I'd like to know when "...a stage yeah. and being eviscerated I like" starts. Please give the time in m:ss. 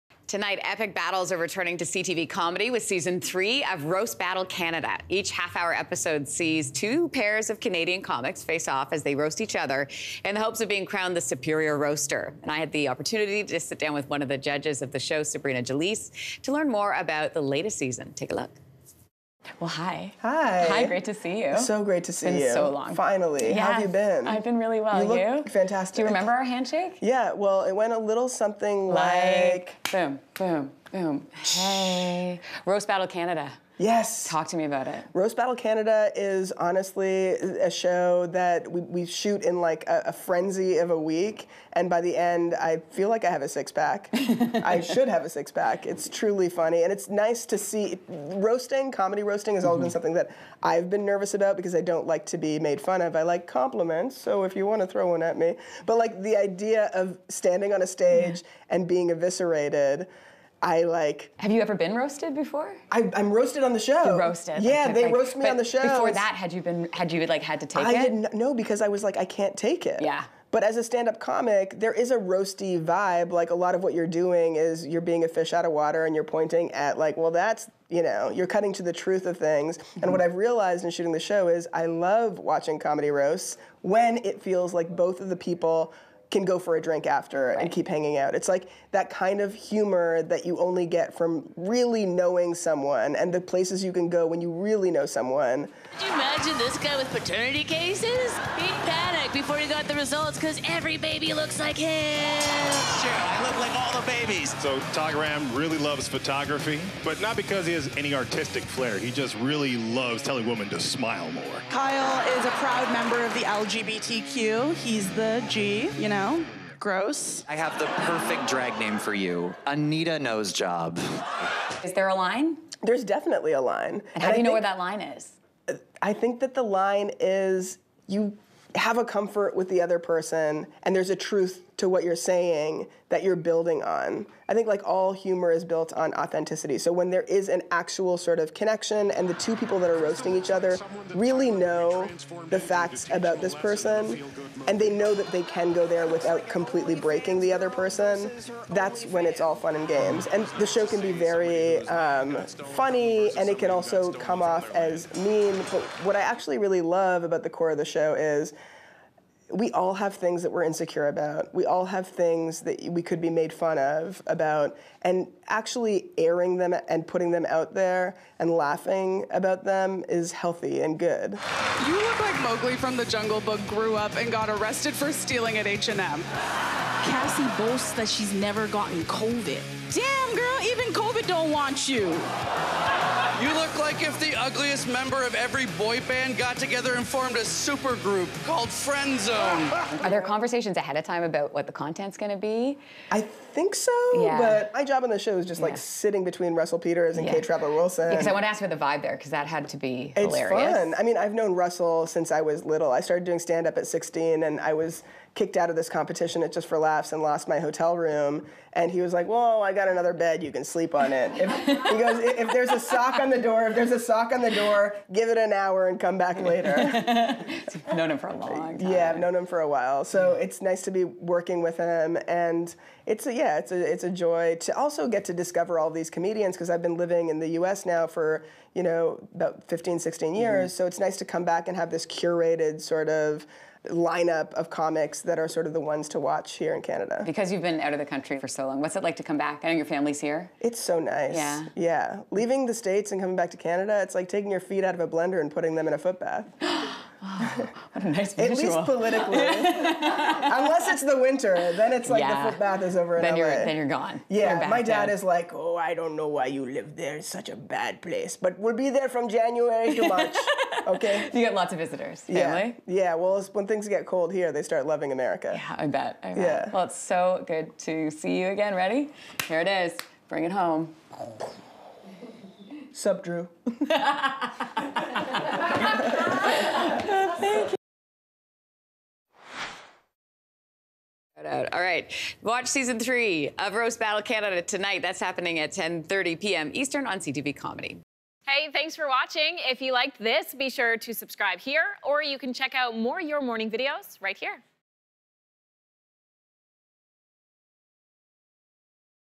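0:57.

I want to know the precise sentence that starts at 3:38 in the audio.
Yeah, I've known him for a while, so yeah.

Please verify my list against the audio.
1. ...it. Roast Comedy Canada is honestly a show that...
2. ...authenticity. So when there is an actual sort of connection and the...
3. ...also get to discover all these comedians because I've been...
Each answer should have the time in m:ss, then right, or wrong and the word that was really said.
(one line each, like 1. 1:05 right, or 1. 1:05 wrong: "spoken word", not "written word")
1. 0:34 wrong: "Battle", not "Comedy"
2. 2:16 right
3. 3:44 right.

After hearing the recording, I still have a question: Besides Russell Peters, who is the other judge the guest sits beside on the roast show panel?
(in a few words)
Kate Trapper Wilson.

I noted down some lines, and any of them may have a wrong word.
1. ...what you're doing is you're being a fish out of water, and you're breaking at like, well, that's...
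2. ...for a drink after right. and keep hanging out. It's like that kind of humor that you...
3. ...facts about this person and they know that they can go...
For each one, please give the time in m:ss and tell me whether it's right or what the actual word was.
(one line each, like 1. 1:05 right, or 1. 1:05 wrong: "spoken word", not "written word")
1. 1:13 wrong: "pointing", not "breaking"
2. 1:26 right
3. 2:22 right.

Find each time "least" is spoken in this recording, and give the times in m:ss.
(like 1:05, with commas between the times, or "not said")
4:08.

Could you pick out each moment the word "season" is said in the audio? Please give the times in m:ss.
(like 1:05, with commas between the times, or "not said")
0:02, 0:17, 4:42.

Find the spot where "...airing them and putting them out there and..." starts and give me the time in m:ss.
2:46.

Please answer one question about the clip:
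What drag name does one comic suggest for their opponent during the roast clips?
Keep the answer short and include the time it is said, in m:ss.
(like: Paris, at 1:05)
Anita Nose Job, at 1:59.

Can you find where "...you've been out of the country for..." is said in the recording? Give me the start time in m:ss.
3:57.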